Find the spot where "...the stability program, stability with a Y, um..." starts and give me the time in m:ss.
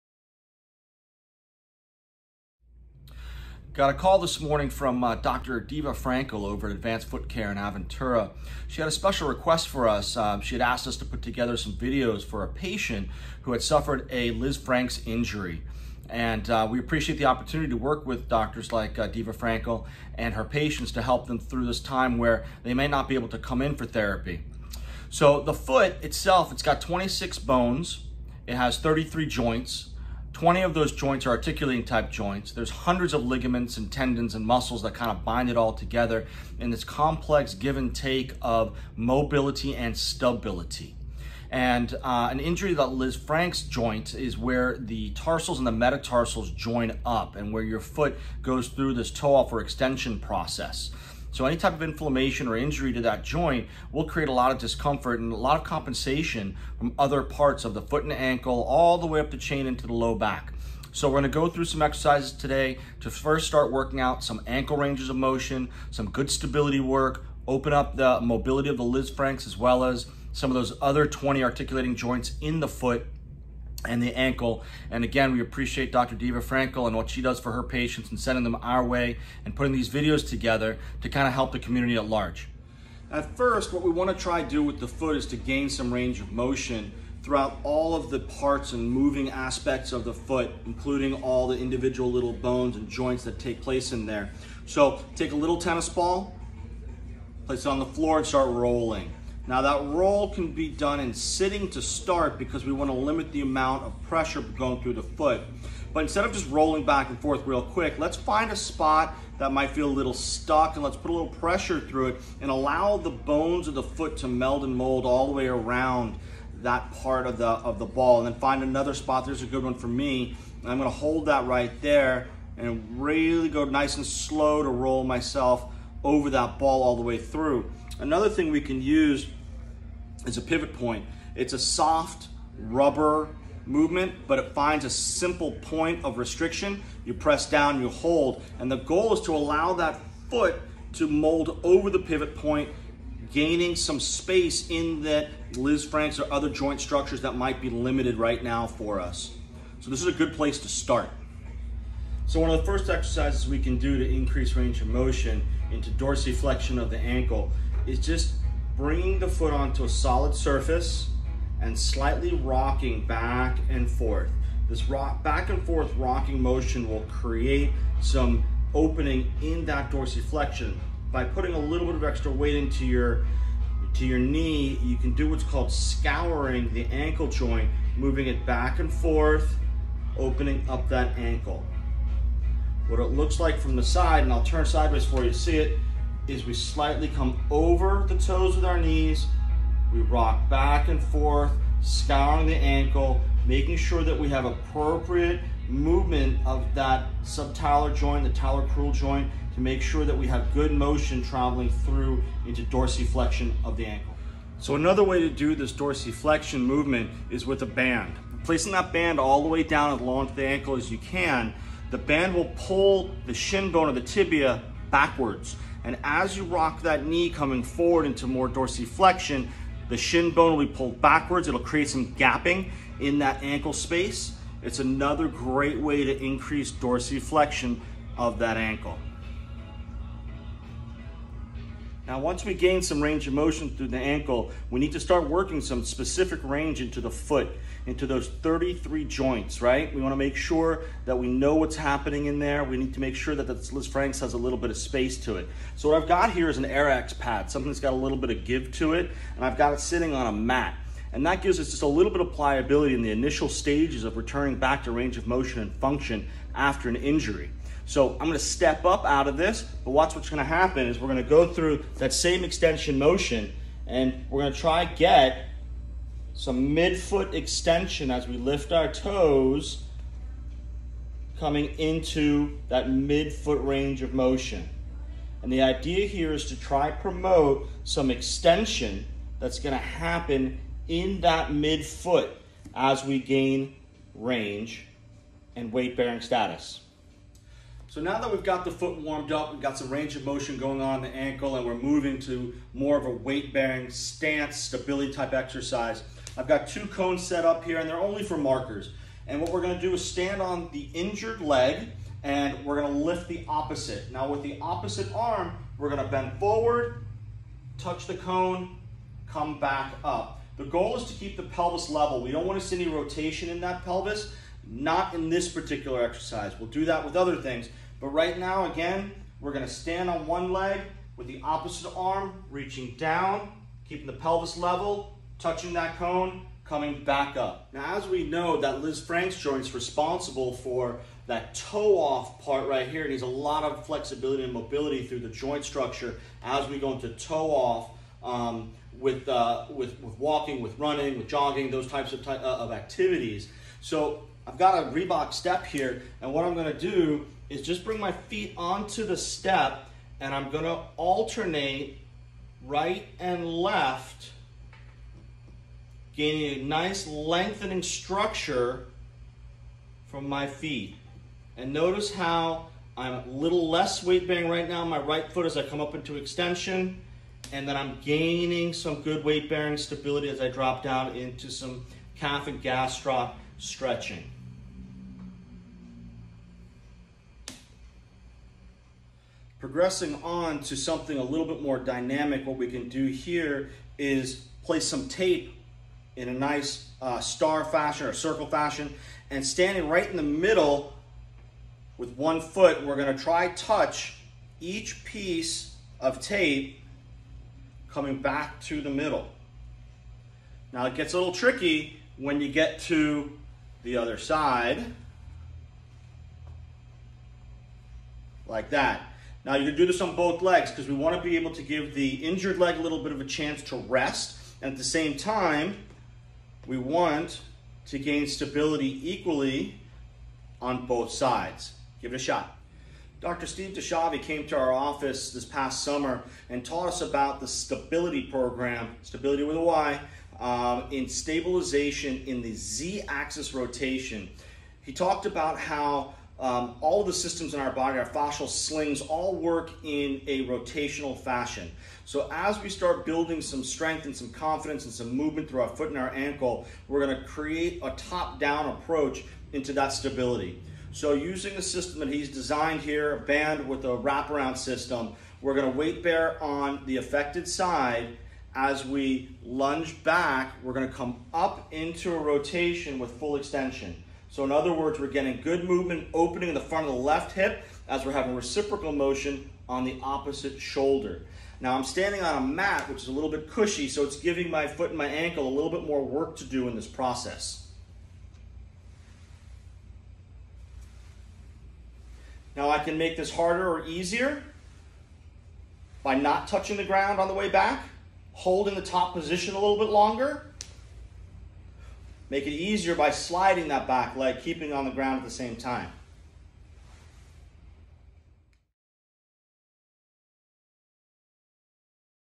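7:07.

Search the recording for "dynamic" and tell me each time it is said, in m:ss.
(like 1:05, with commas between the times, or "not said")
6:21.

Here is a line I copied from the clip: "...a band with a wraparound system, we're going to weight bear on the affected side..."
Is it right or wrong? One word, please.
right.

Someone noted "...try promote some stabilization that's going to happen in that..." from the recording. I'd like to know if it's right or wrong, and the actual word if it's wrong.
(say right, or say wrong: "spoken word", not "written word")
wrong: "extension", not "stabilization".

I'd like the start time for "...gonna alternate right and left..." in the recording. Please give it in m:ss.
5:50.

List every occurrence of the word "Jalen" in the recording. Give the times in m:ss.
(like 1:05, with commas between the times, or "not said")
not said.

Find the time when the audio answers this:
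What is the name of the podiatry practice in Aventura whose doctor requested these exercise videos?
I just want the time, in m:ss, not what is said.
0:06.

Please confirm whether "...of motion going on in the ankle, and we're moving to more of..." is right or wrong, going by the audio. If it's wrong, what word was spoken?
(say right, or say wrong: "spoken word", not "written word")
right.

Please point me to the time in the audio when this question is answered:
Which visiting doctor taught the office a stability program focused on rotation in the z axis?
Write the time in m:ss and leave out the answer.
7:03.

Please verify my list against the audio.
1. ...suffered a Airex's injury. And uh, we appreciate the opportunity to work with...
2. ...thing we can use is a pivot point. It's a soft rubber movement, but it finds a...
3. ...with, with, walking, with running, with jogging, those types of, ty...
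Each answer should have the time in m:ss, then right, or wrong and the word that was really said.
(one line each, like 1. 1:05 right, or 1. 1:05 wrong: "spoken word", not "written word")
1. 0:13 wrong: "Lisfranc", not "Airex"
2. 2:08 right
3. 5:39 right.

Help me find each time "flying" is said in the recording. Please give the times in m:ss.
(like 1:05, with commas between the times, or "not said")
not said.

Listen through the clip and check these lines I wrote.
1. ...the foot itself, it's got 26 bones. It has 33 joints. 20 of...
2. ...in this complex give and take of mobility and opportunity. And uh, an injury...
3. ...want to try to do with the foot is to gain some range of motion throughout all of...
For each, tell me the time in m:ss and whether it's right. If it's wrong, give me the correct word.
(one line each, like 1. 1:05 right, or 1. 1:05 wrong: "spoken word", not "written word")
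1. 0:25 right
2. 0:36 wrong: "stability", not "opportunity"
3. 1:23 right.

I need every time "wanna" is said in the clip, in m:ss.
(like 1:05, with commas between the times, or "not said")
1:42, 4:00, 5:12.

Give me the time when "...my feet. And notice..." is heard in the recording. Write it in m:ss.
6:00.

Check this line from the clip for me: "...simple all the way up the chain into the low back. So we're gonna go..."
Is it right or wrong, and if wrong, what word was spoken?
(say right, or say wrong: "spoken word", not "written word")
wrong: "ankle", not "simple".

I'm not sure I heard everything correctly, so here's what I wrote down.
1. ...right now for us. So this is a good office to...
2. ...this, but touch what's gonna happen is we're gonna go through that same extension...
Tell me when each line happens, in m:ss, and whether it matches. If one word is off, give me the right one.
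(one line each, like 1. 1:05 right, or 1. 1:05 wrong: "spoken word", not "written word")
1. 2:28 wrong: "place", not "office"
2. 4:19 wrong: "watch", not "touch".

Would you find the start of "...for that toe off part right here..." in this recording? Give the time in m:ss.
5:30.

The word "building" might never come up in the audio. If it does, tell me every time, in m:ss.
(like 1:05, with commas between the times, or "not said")
7:23.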